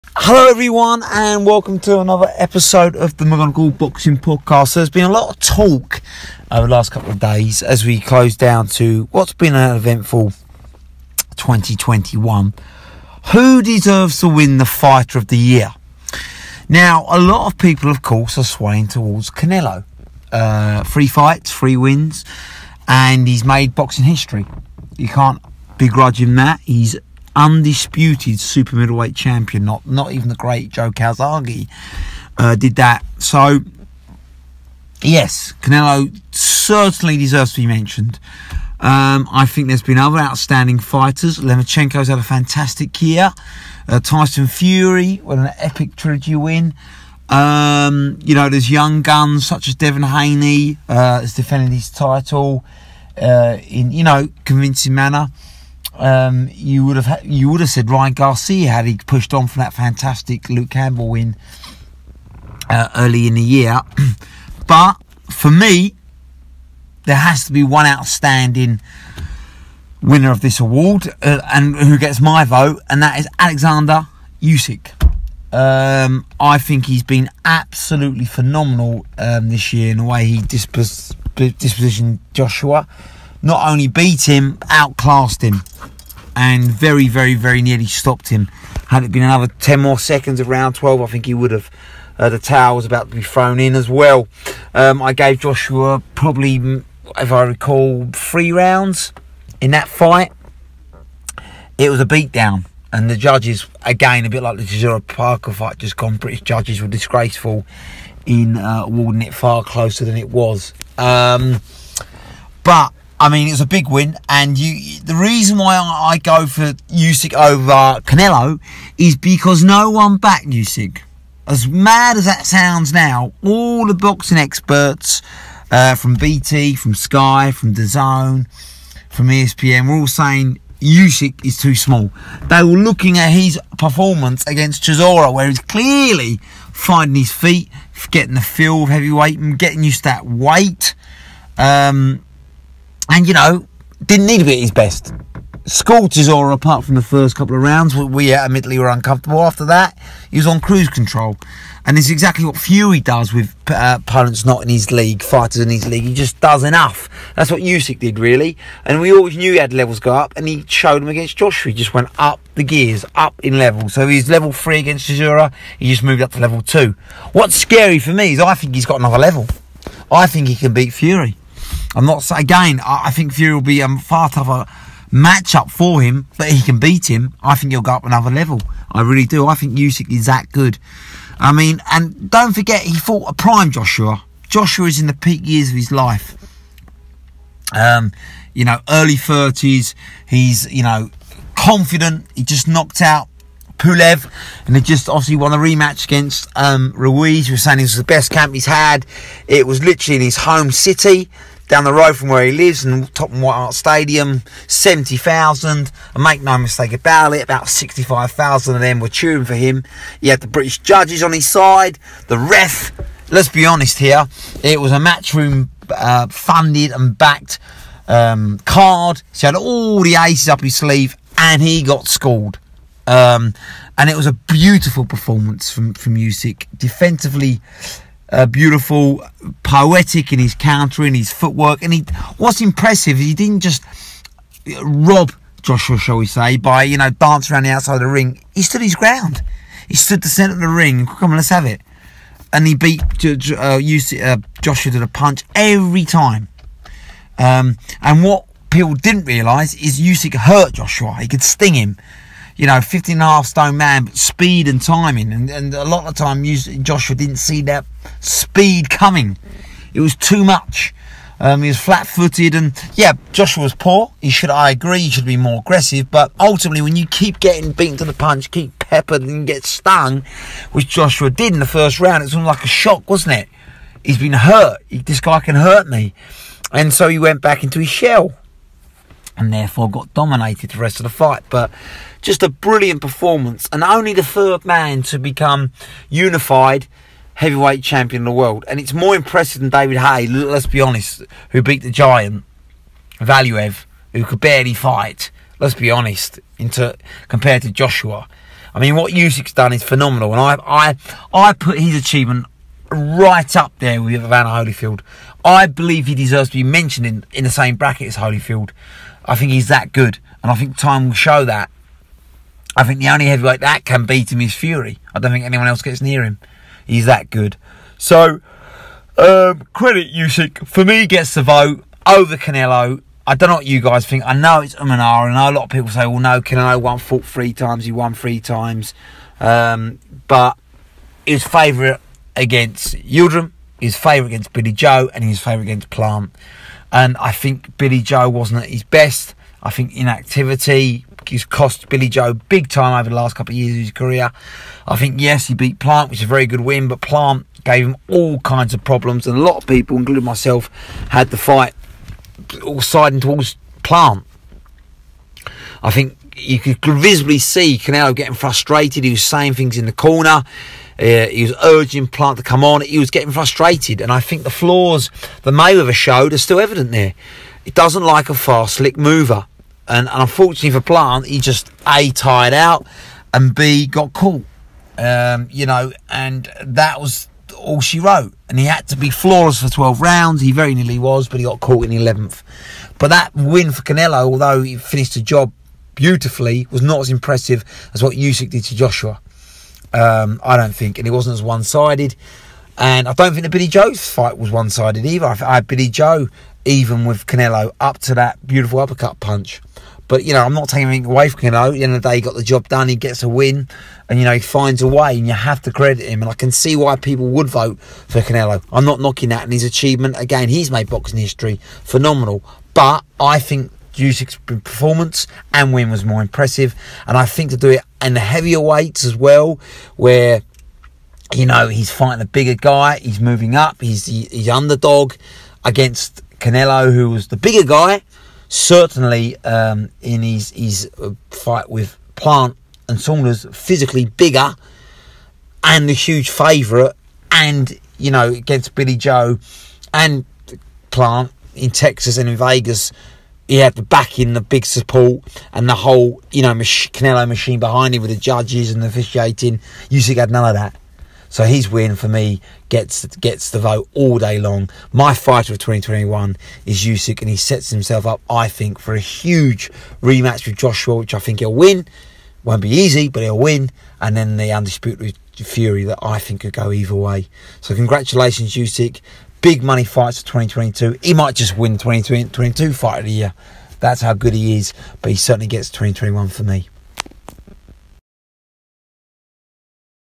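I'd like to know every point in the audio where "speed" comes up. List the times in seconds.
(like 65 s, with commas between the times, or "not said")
254 s, 258 s.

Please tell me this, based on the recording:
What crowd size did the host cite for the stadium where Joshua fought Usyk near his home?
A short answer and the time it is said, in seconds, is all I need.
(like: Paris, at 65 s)
70,000, at 204 s.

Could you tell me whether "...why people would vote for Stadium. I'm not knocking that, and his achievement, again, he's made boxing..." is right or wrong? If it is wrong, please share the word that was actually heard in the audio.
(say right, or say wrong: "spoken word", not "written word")
wrong: "Canelo", not "Stadium".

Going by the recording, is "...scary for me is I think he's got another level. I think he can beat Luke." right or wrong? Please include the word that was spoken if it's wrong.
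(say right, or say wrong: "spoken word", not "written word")
wrong: "Fury", not "Luke".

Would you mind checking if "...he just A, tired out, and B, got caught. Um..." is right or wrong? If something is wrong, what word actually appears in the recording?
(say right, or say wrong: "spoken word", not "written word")
right.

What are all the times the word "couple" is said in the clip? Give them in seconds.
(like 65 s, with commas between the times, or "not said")
6 s, 147 s, 343 s.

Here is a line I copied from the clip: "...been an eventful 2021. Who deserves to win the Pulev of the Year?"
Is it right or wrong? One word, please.
wrong.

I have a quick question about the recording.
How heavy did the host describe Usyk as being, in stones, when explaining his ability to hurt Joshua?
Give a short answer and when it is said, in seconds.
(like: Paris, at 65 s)
15 and a half stone, at 252 s.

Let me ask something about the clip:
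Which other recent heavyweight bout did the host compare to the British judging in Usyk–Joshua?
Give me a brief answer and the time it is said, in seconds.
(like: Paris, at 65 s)
Chisora Parker, at 104 s.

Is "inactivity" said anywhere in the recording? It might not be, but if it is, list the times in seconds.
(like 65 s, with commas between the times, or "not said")
339 s.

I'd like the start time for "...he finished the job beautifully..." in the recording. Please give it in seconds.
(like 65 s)
384 s.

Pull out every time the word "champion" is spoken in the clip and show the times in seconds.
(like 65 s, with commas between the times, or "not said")
29 s, 287 s.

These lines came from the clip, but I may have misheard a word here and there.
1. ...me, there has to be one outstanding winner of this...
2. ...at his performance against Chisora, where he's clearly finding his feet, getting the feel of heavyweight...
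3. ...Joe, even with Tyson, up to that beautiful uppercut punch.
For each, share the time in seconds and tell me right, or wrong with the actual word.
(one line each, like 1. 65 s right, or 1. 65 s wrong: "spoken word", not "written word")
1. 65 s right
2. 133 s right
3. 395 s wrong: "Canelo", not "Tyson".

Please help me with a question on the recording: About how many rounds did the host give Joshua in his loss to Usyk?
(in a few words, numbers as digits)
3.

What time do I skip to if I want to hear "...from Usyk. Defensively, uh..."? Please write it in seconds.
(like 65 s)
225 s.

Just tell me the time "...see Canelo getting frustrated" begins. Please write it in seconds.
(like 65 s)
357 s.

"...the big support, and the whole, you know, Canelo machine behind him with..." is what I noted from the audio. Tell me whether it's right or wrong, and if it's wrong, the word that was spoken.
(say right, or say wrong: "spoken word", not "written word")
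right.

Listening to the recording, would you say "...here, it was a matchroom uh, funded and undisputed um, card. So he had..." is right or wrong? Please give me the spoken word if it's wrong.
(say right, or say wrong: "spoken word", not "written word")
wrong: "backed", not "undisputed".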